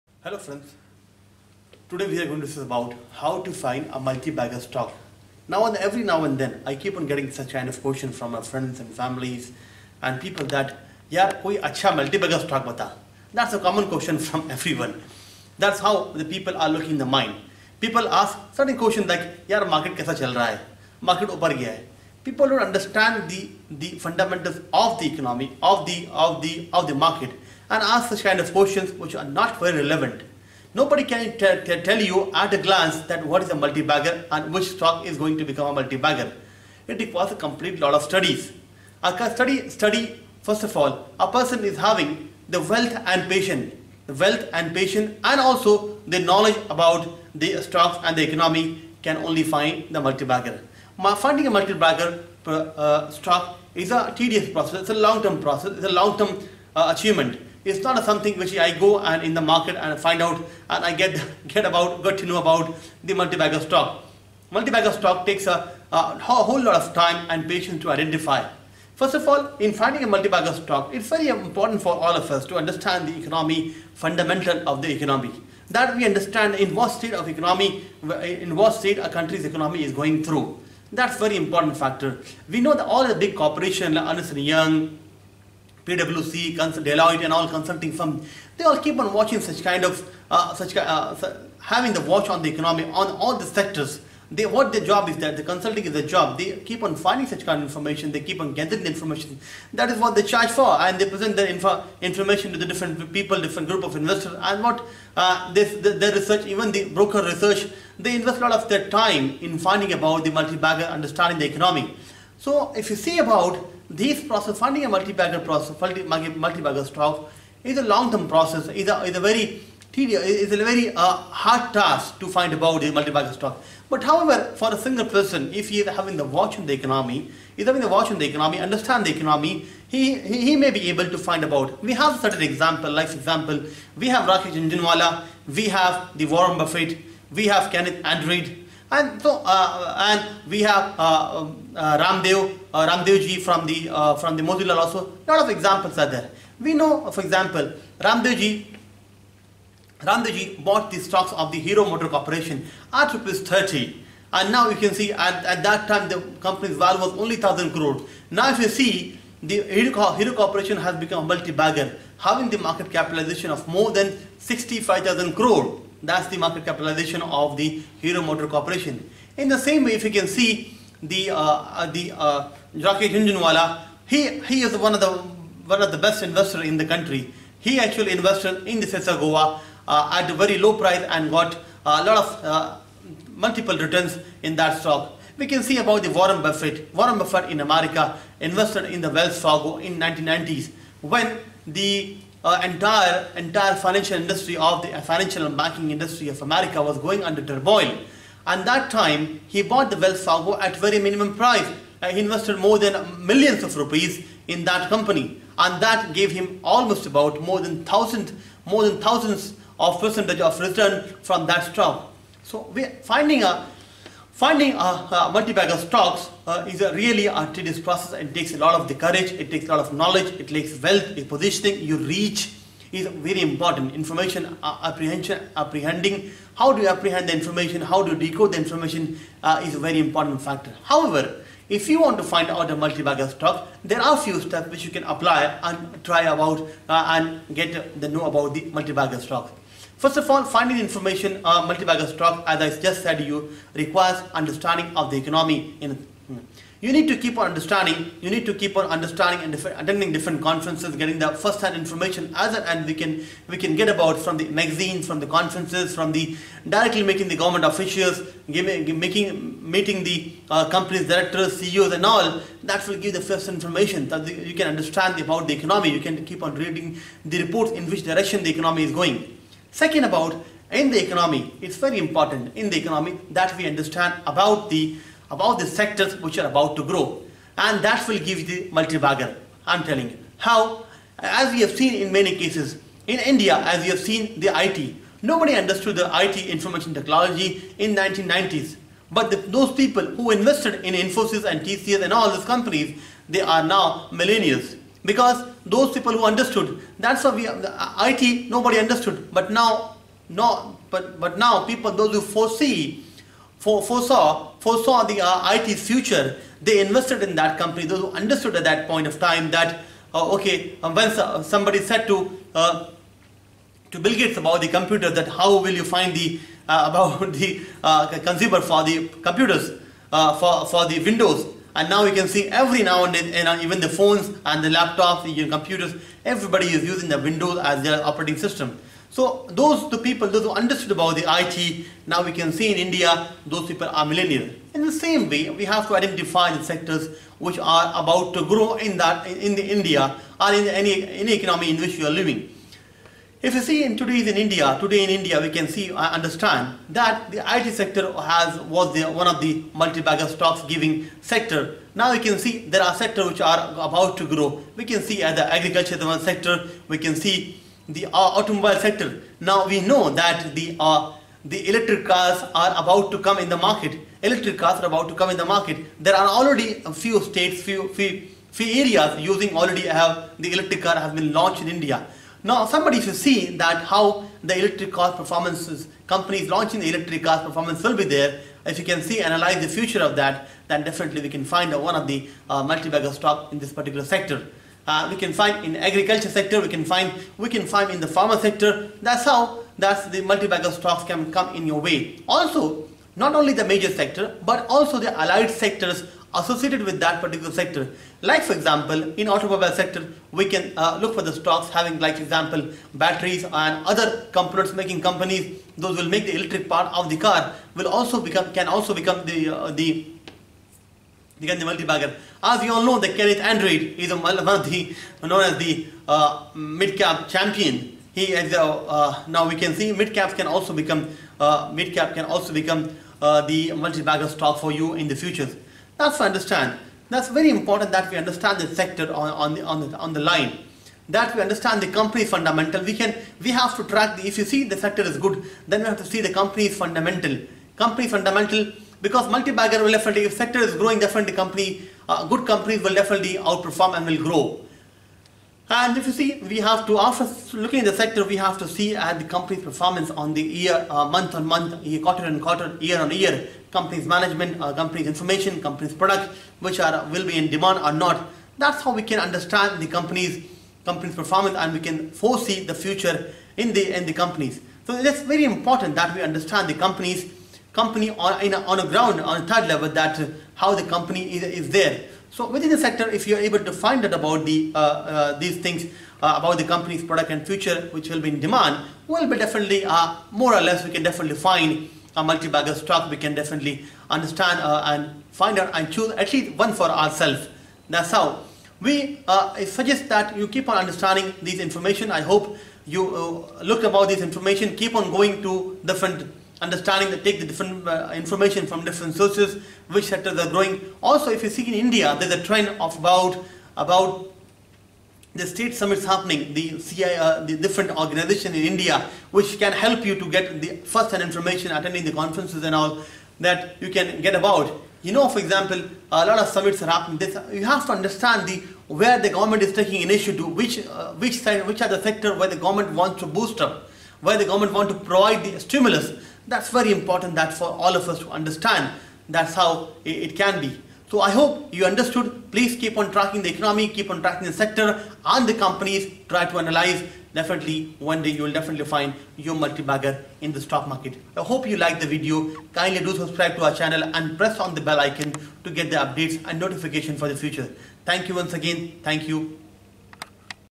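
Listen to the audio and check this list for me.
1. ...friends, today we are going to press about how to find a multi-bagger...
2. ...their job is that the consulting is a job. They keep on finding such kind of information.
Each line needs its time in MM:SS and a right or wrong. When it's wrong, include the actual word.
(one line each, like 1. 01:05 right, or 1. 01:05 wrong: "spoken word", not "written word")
1. 00:00 wrong: "discuss", not "press"
2. 01:34 right.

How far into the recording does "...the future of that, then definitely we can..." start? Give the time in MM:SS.
06:19.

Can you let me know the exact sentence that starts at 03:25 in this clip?
And that gave him almost about more than thousand, more than thousands of percentage of return from that stock.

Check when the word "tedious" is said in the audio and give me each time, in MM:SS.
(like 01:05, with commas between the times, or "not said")
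00:54, 01:59, 03:37.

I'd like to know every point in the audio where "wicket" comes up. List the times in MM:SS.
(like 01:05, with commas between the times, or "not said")
not said.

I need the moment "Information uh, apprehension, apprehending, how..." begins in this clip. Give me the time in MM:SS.
03:43.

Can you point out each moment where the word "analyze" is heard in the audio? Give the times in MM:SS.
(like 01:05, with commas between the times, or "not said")
06:19, 08:56.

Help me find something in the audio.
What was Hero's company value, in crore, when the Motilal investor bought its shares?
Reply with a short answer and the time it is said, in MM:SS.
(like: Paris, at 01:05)
1000 crore, at 02:37.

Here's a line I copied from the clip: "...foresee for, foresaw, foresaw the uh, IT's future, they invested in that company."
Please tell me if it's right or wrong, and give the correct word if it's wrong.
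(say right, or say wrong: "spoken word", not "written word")
right.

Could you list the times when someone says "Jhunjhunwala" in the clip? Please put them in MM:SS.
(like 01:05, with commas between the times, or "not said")
02:14, 02:52.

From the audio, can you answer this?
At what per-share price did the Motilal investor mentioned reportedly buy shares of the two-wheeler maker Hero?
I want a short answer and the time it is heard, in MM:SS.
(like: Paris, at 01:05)
Rs 30, at 02:33.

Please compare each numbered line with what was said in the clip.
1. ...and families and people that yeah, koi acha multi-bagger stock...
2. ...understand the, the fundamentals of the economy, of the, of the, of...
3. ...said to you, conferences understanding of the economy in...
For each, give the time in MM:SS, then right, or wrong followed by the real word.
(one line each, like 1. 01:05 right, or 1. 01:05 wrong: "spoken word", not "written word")
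1. 00:08 right
2. 00:22 right
3. 04:03 wrong: "requires", not "conferences".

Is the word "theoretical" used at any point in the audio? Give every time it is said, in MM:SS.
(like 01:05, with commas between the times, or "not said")
not said.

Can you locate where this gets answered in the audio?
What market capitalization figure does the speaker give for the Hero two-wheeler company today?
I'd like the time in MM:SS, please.
02:44.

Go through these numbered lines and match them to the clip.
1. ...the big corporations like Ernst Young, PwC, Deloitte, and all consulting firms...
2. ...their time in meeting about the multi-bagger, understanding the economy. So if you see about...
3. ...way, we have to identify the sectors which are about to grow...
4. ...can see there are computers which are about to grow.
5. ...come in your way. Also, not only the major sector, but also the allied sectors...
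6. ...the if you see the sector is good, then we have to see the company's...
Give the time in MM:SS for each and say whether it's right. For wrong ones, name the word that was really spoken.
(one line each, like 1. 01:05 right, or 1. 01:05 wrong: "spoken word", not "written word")
1. 01:23 right
2. 01:48 wrong: "finding", not "meeting"
3. 05:35 right
4. 05:52 wrong: "sectors", not "computers"
5. 06:31 right
6. 07:14 right.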